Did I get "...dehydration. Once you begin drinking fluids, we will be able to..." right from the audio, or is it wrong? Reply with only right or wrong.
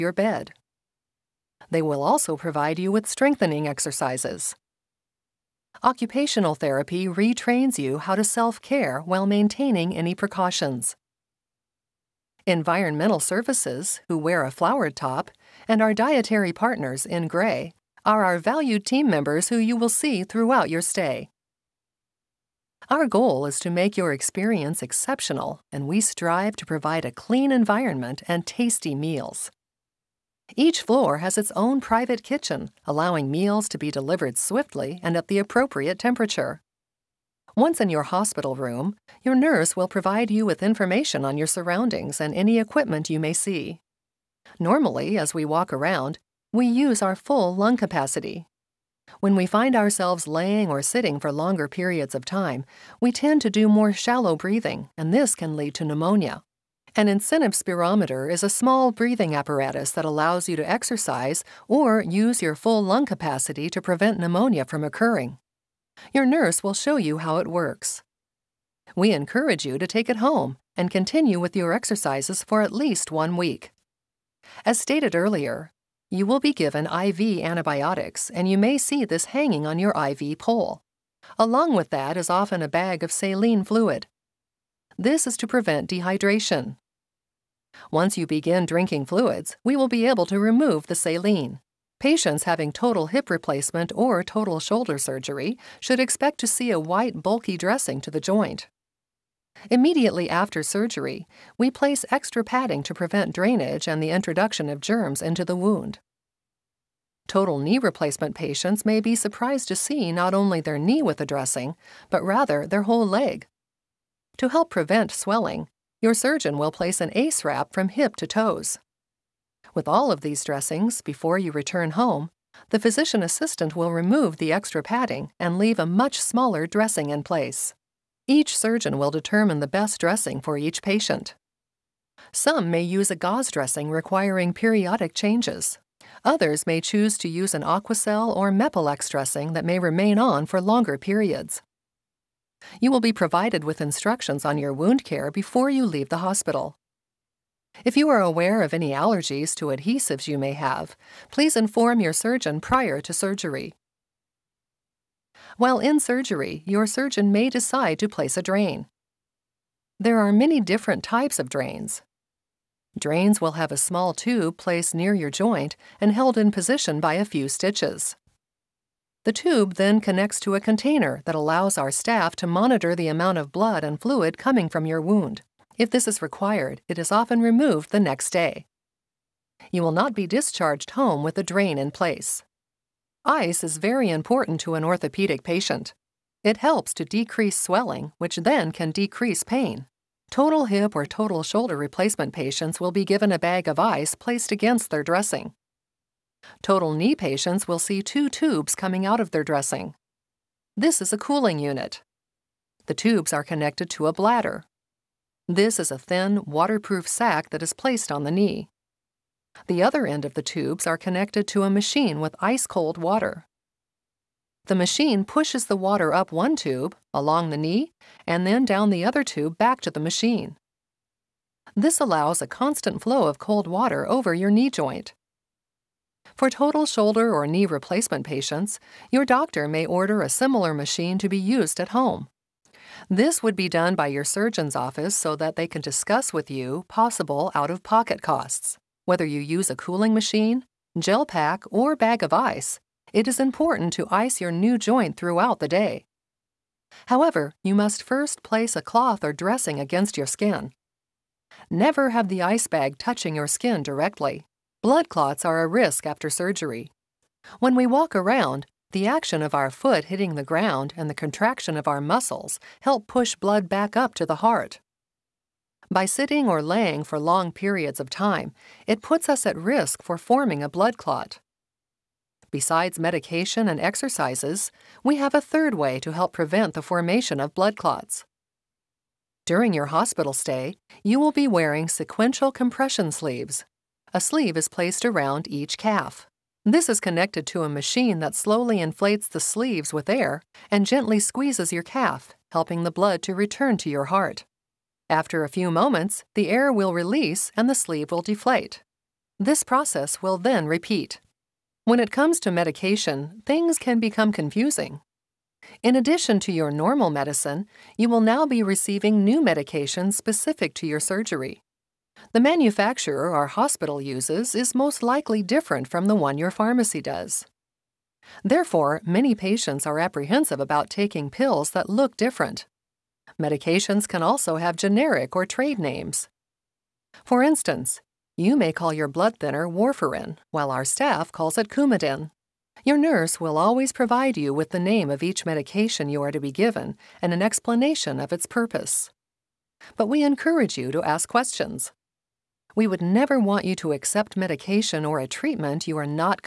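right.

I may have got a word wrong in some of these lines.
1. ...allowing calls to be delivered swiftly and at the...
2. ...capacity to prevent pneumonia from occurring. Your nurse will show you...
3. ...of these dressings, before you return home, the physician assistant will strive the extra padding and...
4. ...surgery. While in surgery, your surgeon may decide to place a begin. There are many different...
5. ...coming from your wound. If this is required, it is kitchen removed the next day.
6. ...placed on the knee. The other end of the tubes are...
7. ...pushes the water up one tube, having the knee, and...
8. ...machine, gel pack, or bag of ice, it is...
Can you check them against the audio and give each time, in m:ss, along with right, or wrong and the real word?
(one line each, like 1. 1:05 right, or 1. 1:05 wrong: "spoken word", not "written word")
1. 0:32 wrong: "meals", not "calls"
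2. 1:03 right
3. 2:00 wrong: "remove", not "strive"
4. 2:33 wrong: "drain", not "begin"
5. 2:54 wrong: "often", not "kitchen"
6. 3:27 right
7. 3:35 wrong: "along", not "having"
8. 4:00 right.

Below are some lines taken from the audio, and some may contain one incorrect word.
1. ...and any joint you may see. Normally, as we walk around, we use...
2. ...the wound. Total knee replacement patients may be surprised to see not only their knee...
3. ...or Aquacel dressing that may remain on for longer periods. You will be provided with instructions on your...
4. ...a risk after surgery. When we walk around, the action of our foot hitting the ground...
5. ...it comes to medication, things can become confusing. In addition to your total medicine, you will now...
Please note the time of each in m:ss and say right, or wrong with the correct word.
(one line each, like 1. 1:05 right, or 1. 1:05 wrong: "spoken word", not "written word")
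1. 0:42 wrong: "equipment", not "joint"
2. 1:45 right
3. 2:18 wrong: "Mepilex", not "Aquacel"
4. 4:15 right
5. 5:01 wrong: "normal", not "total".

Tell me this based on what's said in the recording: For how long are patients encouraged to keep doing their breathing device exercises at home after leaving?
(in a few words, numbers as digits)
at least one week.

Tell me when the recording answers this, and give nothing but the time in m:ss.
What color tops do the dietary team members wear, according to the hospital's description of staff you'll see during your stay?
0:17.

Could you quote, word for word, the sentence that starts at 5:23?
Medications can also have generic or trade names.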